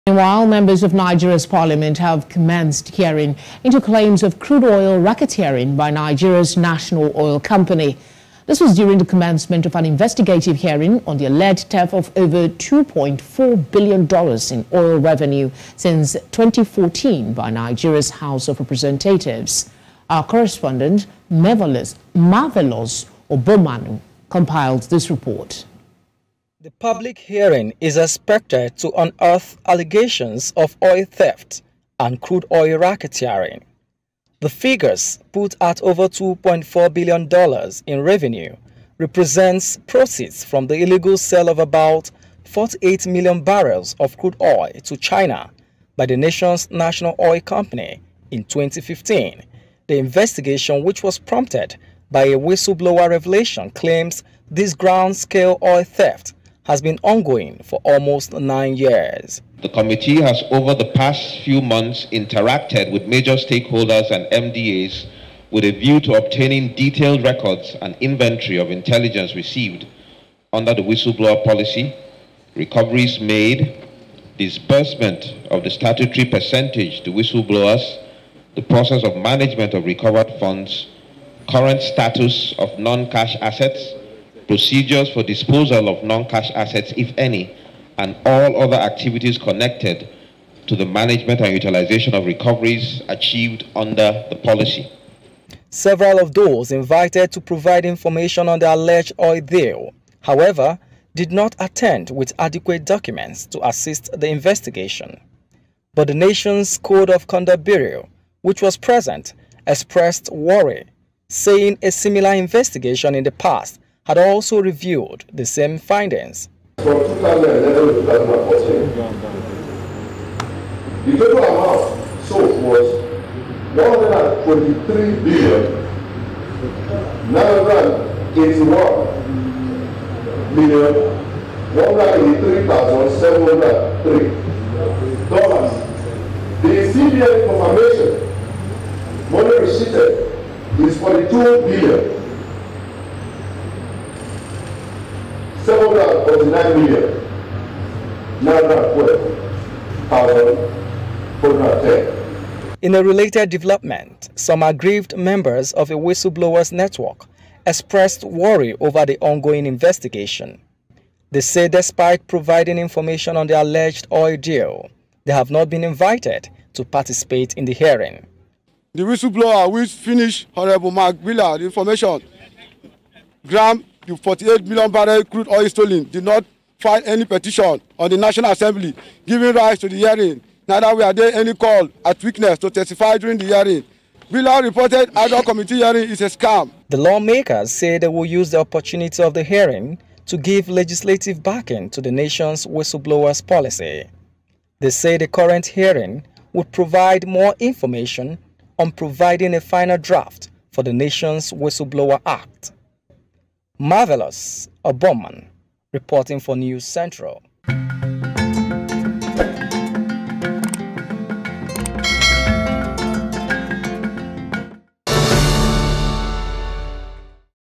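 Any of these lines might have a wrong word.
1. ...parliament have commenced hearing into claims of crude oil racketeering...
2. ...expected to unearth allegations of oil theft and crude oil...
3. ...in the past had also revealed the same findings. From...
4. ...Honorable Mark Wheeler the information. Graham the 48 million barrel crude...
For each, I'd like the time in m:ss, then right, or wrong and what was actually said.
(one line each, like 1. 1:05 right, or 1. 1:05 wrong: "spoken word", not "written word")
1. 0:01 right
2. 0:27 right
3. 1:53 right
4. 2:50 right.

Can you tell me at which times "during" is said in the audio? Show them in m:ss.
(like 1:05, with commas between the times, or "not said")
0:08, 3:03.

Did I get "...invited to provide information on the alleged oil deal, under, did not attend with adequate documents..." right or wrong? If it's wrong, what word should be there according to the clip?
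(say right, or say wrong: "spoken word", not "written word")
wrong: "however", not "under".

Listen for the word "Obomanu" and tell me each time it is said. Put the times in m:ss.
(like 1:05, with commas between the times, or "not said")
0:23, 3:24.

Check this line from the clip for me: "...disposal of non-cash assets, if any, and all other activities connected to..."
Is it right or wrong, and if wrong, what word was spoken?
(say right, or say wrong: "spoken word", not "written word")
right.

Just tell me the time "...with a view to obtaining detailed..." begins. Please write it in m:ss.
1:05.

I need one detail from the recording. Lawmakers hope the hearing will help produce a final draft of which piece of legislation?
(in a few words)
Whistleblower Act.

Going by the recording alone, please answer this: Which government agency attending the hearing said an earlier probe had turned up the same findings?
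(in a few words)
Code of Conduct Bureau.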